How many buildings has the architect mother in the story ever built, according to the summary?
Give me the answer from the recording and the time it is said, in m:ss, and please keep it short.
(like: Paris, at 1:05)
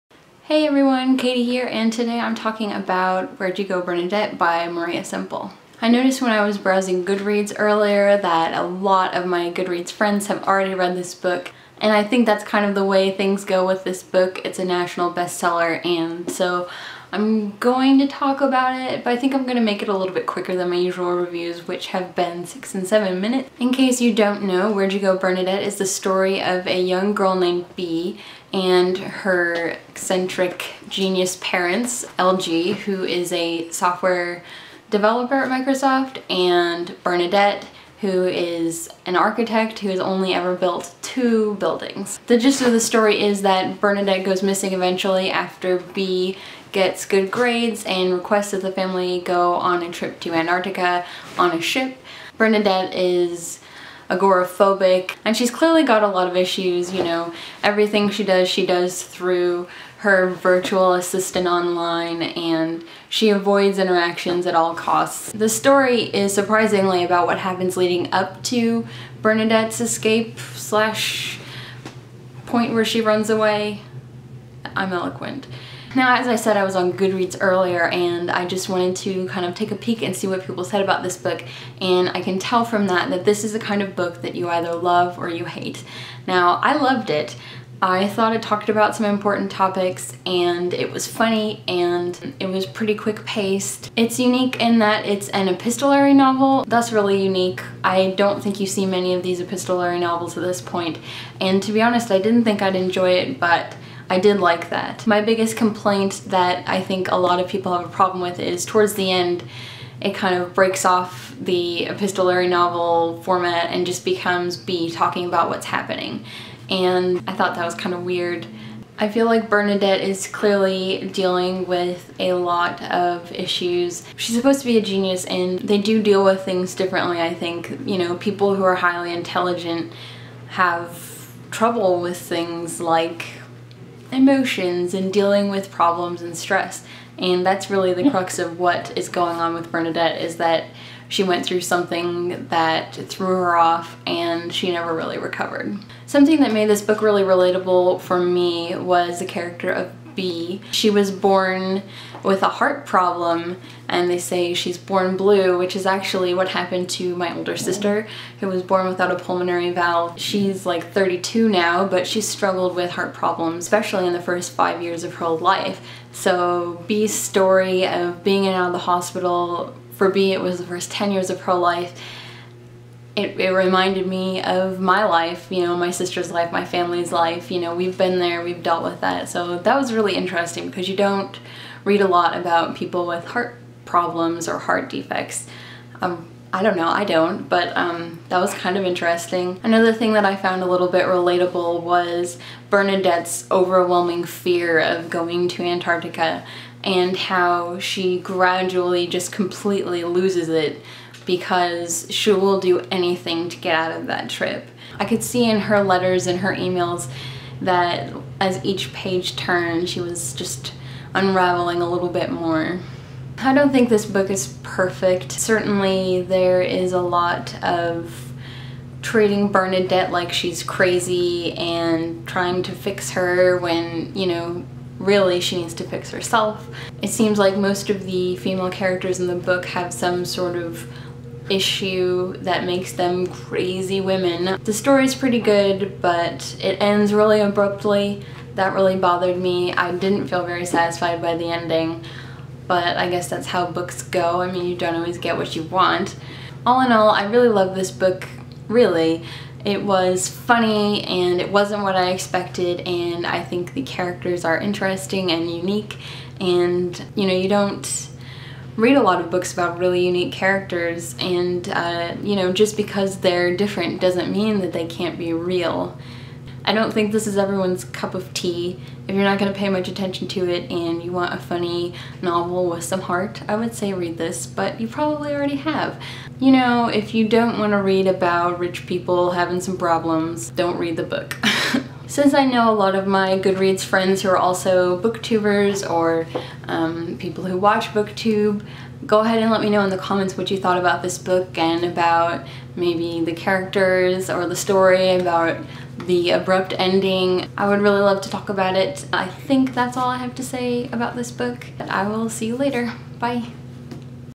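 2, at 0:41.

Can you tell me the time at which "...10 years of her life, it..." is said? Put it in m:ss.
2:50.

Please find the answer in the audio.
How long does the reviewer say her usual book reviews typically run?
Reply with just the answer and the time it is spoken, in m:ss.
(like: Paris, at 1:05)
6 to 7 minutes, at 0:22.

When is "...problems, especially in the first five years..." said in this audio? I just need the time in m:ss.
2:43.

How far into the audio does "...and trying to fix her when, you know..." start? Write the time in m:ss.
3:41.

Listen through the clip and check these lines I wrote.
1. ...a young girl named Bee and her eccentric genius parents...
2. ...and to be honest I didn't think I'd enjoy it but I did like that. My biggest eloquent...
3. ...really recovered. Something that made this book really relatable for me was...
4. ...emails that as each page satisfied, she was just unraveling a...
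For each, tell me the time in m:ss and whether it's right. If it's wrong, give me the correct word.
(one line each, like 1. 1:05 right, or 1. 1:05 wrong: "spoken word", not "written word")
1. 0:26 right
2. 1:41 wrong: "complaint", not "eloquent"
3. 2:24 right
4. 3:26 wrong: "turned", not "satisfied".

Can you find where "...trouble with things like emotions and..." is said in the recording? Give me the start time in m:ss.
2:11.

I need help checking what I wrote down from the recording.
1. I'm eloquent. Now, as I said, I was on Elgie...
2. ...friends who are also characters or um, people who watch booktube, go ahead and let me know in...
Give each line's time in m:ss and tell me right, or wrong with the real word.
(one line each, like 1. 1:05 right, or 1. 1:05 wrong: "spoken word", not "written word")
1. 1:14 wrong: "Goodreads", not "Elgie"
2. 4:43 wrong: "booktubers", not "characters".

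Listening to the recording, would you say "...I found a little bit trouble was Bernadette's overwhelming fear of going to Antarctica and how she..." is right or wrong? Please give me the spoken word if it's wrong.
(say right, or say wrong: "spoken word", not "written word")
wrong: "relatable", not "trouble".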